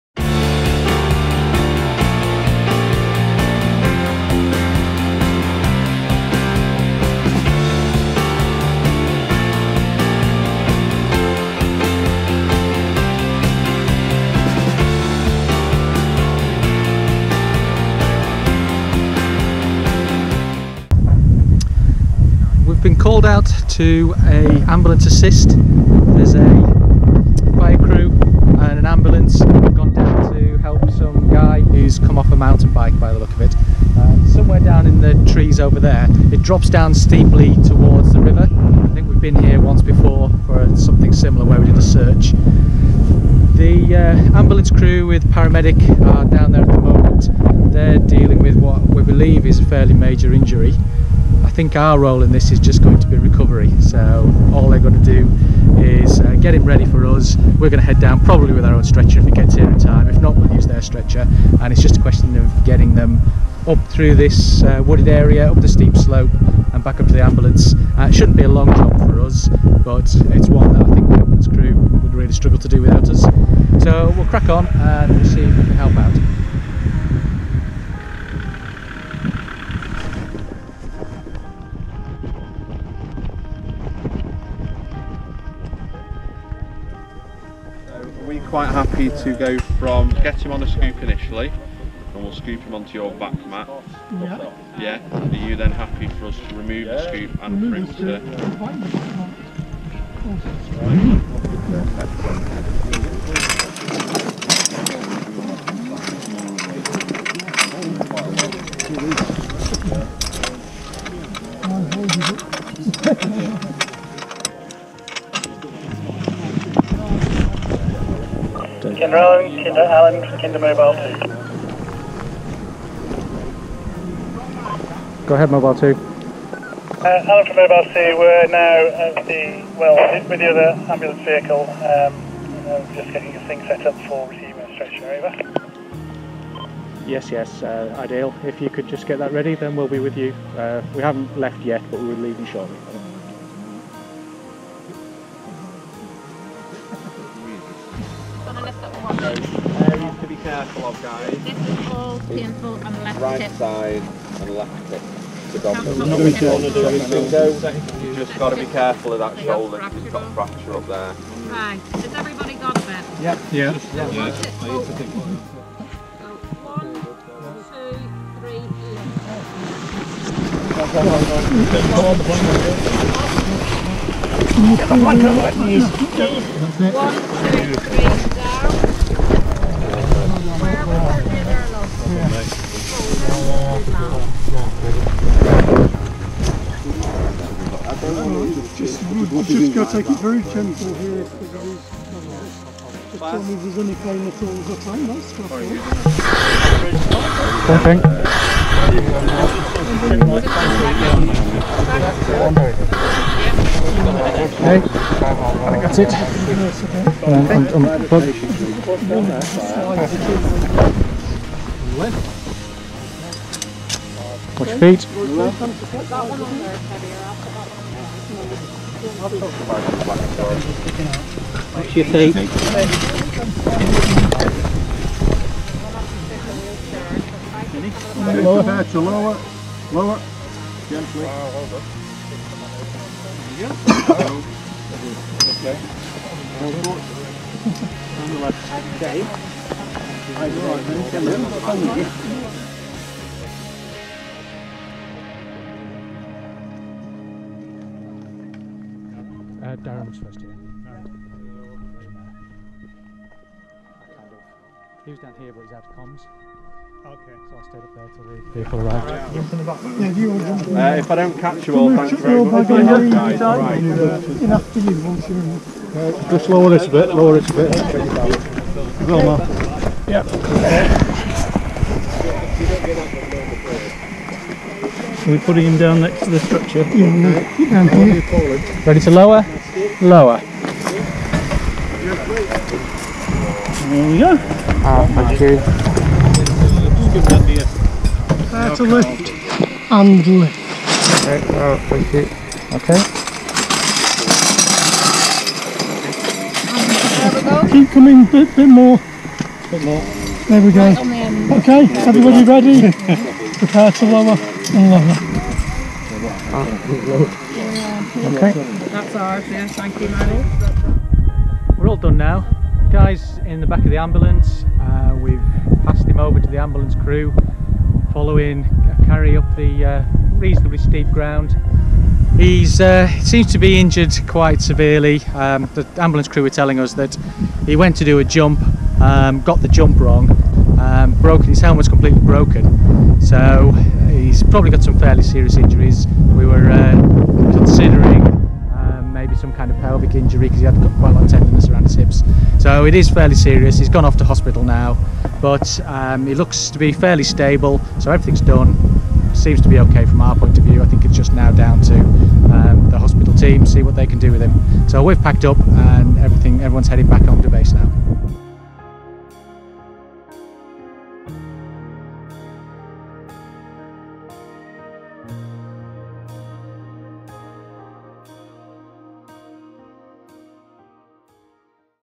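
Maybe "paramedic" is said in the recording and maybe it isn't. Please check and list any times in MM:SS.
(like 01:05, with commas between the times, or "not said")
00:45.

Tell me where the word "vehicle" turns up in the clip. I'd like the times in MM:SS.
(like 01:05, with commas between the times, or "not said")
02:11, 04:18.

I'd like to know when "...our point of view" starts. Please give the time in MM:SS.
05:50.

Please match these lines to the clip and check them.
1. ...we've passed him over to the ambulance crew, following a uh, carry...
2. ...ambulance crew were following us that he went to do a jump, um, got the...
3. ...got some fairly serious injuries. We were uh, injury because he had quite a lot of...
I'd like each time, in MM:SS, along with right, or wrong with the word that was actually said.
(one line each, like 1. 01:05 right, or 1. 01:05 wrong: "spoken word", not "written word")
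1. 05:15 right
2. 05:25 wrong: "telling", not "following"
3. 05:34 right.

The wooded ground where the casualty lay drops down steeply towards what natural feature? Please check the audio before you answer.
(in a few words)
the river.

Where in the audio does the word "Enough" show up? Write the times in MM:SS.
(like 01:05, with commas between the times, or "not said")
04:24.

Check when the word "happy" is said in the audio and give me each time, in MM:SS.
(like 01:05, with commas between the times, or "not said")
01:28, 01:35.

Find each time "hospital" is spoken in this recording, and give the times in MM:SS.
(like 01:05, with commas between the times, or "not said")
05:44, 05:52.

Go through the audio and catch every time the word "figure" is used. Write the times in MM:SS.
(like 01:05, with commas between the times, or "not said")
not said.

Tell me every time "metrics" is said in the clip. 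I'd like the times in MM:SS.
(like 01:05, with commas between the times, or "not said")
not said.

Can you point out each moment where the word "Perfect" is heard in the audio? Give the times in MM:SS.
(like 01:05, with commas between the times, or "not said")
01:43.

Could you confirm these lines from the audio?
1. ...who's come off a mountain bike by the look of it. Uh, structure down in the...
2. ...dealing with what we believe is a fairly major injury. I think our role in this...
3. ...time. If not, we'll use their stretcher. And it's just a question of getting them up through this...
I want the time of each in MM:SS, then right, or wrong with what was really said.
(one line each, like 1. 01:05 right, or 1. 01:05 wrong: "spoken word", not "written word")
1. 00:31 wrong: "somewhere", not "structure"
2. 00:47 right
3. 00:59 right.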